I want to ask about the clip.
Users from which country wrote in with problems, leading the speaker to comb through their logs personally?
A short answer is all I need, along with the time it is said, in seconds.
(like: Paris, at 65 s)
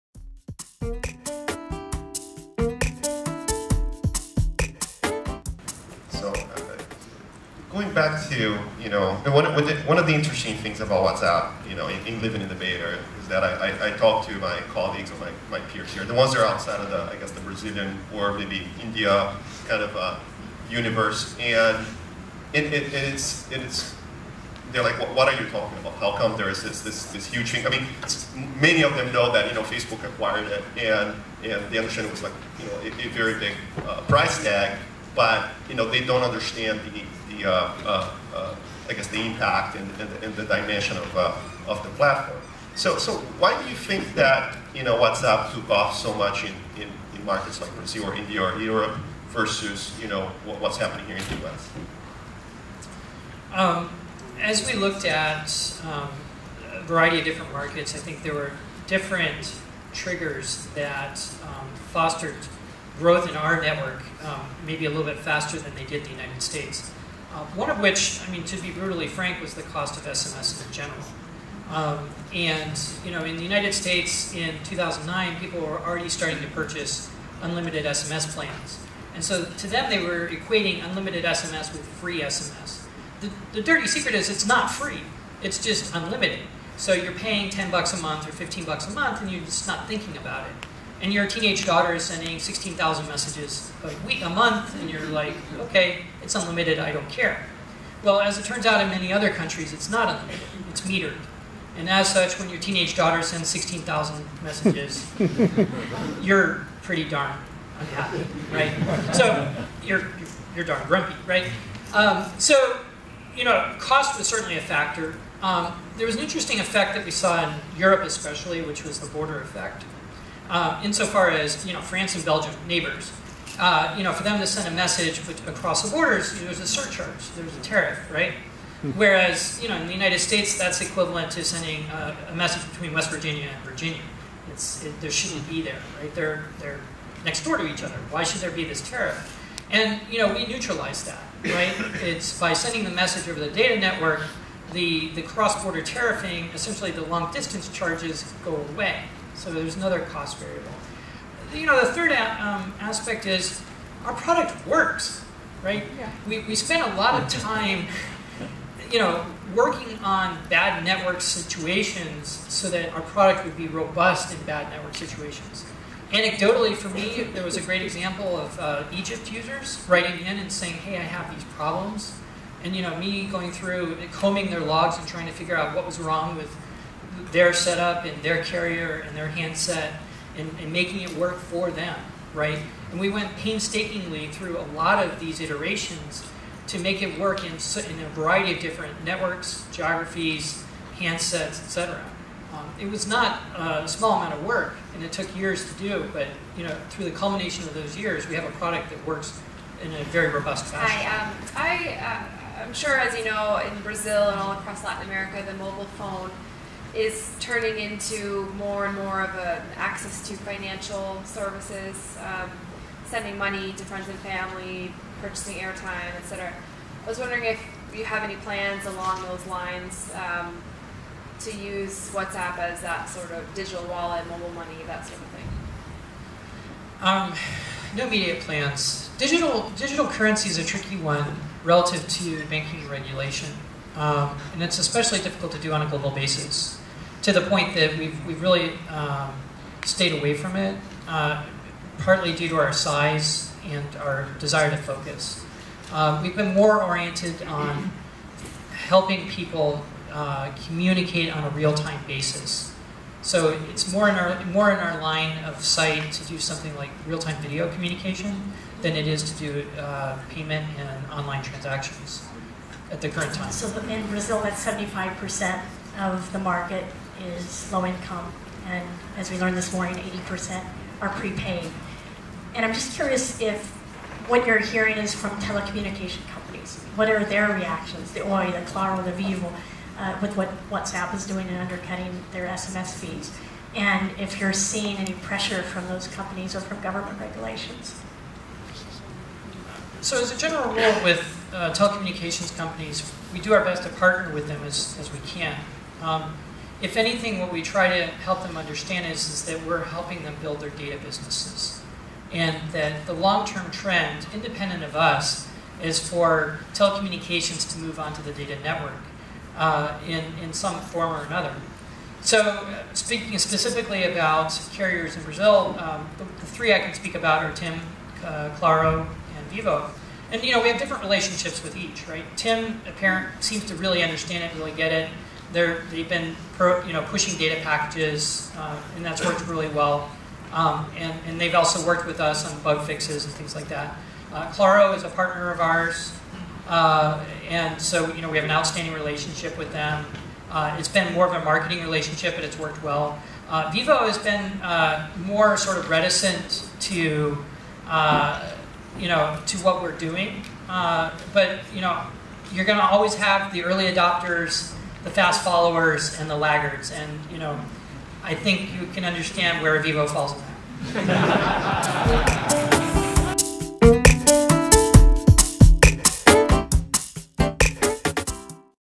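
Egypt, at 168 s.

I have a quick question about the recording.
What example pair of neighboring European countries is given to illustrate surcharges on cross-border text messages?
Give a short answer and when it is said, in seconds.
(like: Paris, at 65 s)
France and Belgium, at 121 s.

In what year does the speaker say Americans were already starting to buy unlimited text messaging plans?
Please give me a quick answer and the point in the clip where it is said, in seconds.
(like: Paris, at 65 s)
2009, at 74 s.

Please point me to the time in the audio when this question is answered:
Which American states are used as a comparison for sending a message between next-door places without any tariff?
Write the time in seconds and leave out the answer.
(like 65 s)
132 s.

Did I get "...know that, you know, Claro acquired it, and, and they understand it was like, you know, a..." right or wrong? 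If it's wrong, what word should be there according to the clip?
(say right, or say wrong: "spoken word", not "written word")
wrong: "Facebook", not "Claro".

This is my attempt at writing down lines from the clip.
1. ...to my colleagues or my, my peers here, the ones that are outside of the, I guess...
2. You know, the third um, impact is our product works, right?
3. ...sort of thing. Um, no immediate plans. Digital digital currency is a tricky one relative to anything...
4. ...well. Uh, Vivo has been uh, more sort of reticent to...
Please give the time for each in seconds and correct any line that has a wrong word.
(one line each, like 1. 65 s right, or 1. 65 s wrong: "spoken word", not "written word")
1. 14 s right
2. 151 s wrong: "aspect", not "impact"
3. 225 s wrong: "banking", not "anything"
4. 342 s right.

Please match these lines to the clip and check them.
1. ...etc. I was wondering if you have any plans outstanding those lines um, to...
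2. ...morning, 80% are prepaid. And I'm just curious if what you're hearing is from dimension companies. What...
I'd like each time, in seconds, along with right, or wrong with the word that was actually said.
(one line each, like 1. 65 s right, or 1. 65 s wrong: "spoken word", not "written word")
1. 216 s wrong: "along", not "outstanding"
2. 269 s wrong: "telecommunication", not "dimension".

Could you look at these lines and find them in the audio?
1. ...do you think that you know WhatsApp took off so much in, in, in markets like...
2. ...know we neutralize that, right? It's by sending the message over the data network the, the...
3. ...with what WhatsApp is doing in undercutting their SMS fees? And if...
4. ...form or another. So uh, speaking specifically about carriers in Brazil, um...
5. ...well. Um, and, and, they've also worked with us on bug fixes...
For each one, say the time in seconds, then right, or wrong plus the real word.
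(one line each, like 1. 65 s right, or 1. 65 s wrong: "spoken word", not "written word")
1. 43 s right
2. 140 s right
3. 280 s right
4. 310 s right
5. 329 s right.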